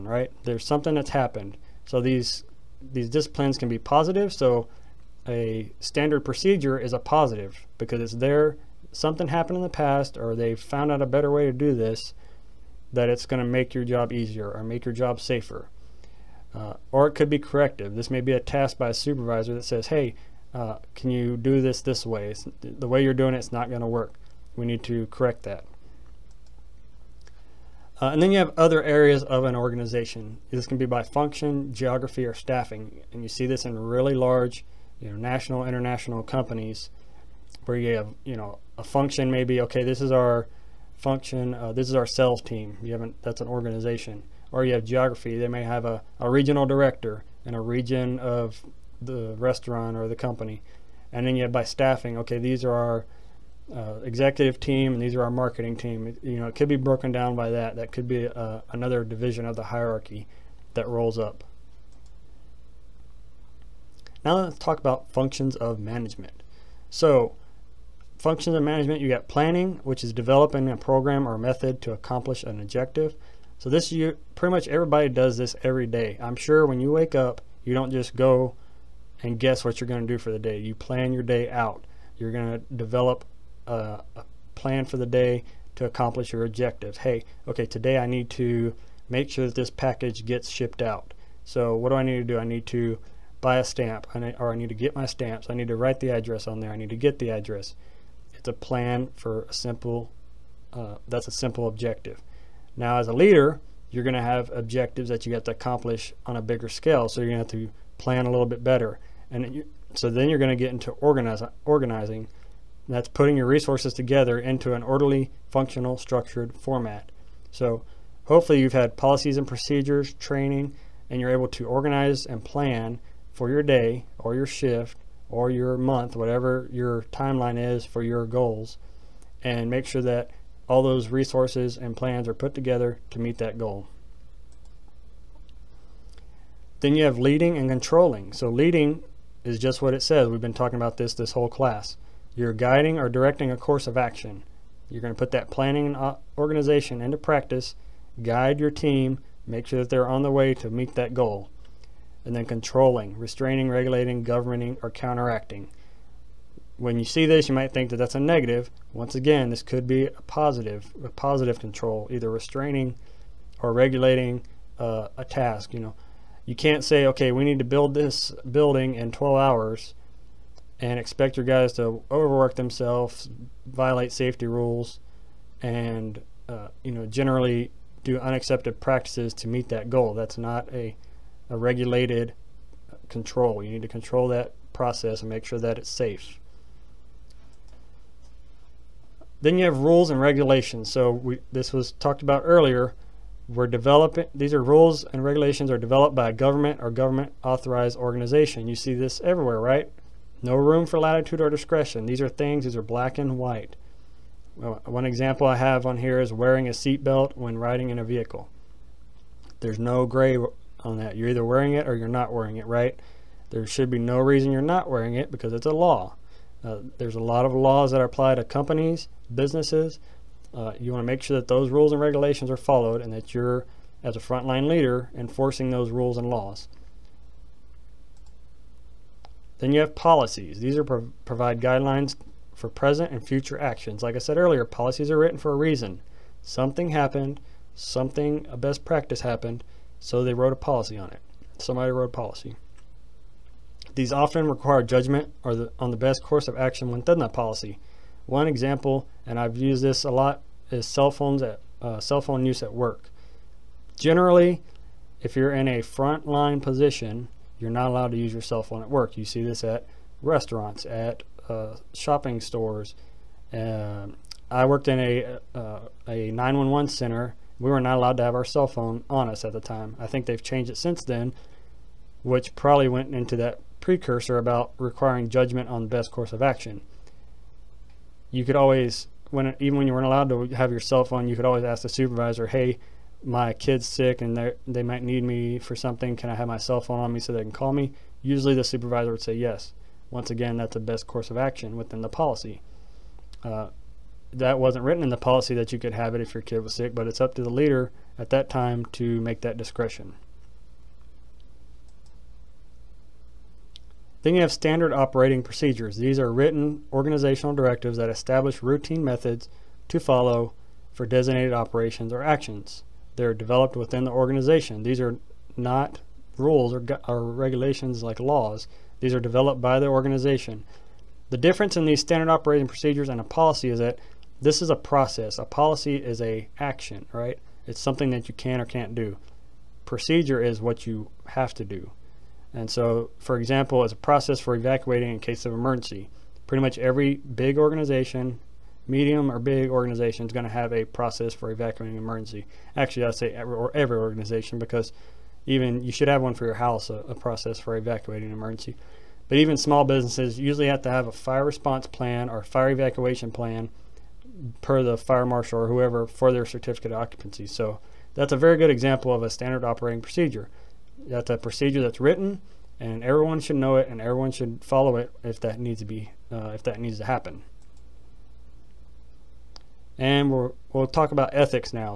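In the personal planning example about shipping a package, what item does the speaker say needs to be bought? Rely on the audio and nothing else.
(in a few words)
A stamp.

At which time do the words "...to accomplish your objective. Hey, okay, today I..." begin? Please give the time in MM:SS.
01:25.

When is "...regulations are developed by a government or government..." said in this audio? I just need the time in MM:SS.
03:15.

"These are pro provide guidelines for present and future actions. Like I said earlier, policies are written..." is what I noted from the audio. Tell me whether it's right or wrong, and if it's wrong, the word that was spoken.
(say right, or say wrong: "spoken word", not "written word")
right.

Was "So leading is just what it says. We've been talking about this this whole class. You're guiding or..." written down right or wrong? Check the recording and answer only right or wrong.
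right.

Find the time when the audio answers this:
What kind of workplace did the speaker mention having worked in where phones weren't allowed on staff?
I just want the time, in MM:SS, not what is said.
04:26.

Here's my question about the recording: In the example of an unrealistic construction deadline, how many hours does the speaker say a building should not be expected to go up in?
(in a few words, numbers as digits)
12.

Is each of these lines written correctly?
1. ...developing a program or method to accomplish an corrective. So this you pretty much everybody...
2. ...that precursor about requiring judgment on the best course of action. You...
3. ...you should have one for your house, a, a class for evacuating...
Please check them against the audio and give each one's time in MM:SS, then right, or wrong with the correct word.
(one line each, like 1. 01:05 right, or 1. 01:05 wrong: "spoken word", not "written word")
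1. 01:10 wrong: "objective", not "corrective"
2. 04:33 right
3. 05:45 wrong: "process", not "class".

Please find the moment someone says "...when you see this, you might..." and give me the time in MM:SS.
02:36.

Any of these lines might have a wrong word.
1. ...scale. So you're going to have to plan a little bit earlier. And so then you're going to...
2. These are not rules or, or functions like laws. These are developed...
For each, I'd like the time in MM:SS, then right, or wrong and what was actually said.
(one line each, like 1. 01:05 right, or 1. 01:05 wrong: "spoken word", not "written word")
1. 01:46 wrong: "better", not "earlier"
2. 05:14 wrong: "regulations", not "functions".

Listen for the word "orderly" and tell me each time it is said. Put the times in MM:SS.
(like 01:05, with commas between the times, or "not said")
01:54.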